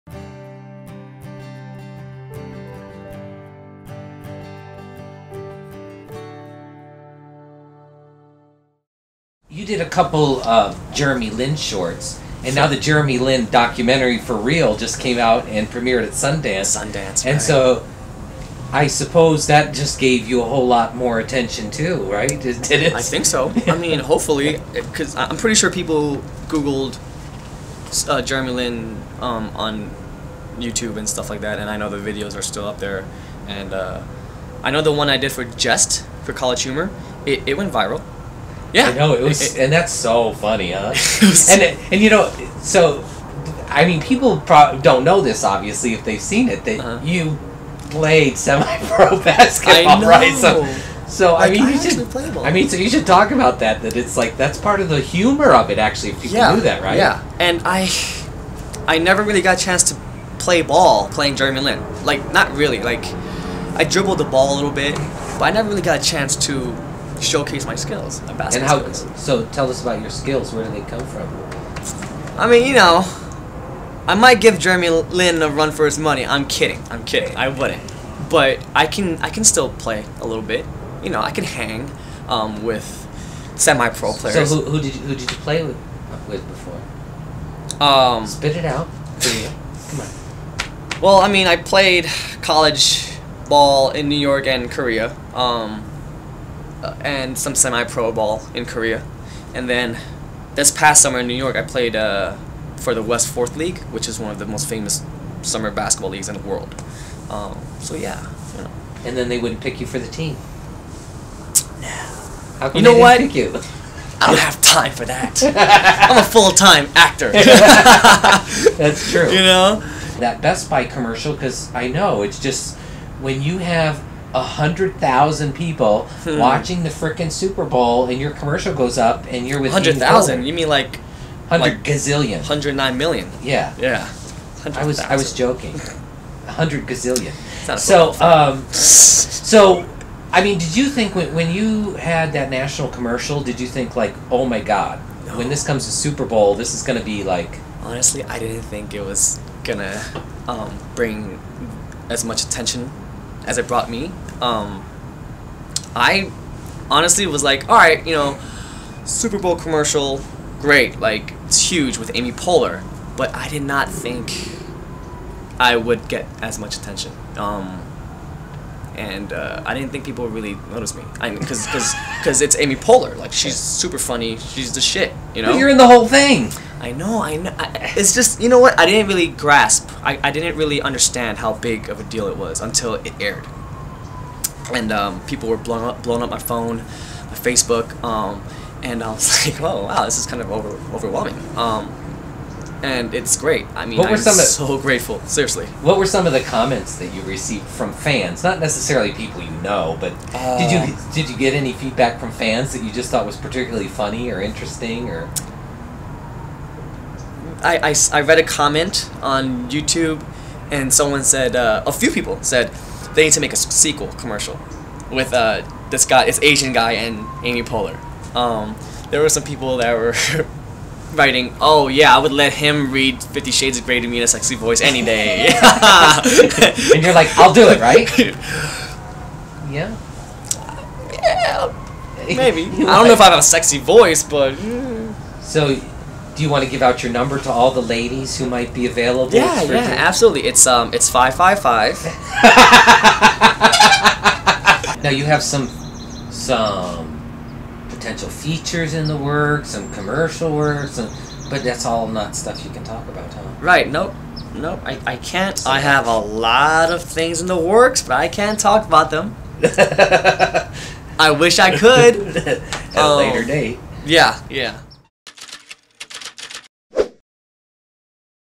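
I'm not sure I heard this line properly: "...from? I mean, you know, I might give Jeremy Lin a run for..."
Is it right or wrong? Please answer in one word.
right.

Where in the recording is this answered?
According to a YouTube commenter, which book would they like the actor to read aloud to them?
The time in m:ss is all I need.
3:43.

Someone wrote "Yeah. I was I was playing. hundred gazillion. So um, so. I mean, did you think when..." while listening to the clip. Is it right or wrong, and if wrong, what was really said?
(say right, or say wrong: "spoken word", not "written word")
wrong: "joking", not "playing".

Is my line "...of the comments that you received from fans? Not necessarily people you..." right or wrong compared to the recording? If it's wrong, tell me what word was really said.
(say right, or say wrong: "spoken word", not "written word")
right.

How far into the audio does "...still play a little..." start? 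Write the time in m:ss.
1:19.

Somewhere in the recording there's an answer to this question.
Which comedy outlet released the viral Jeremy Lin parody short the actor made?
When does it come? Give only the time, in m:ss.
0:36.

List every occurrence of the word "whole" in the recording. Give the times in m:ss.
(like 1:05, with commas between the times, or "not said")
0:20, 2:55.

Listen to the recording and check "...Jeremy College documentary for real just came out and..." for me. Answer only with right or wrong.
wrong.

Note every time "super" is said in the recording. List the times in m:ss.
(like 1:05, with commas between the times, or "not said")
2:07, 2:25, 2:39, 2:53.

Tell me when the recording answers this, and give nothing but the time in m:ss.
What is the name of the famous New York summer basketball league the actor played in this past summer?
1:43.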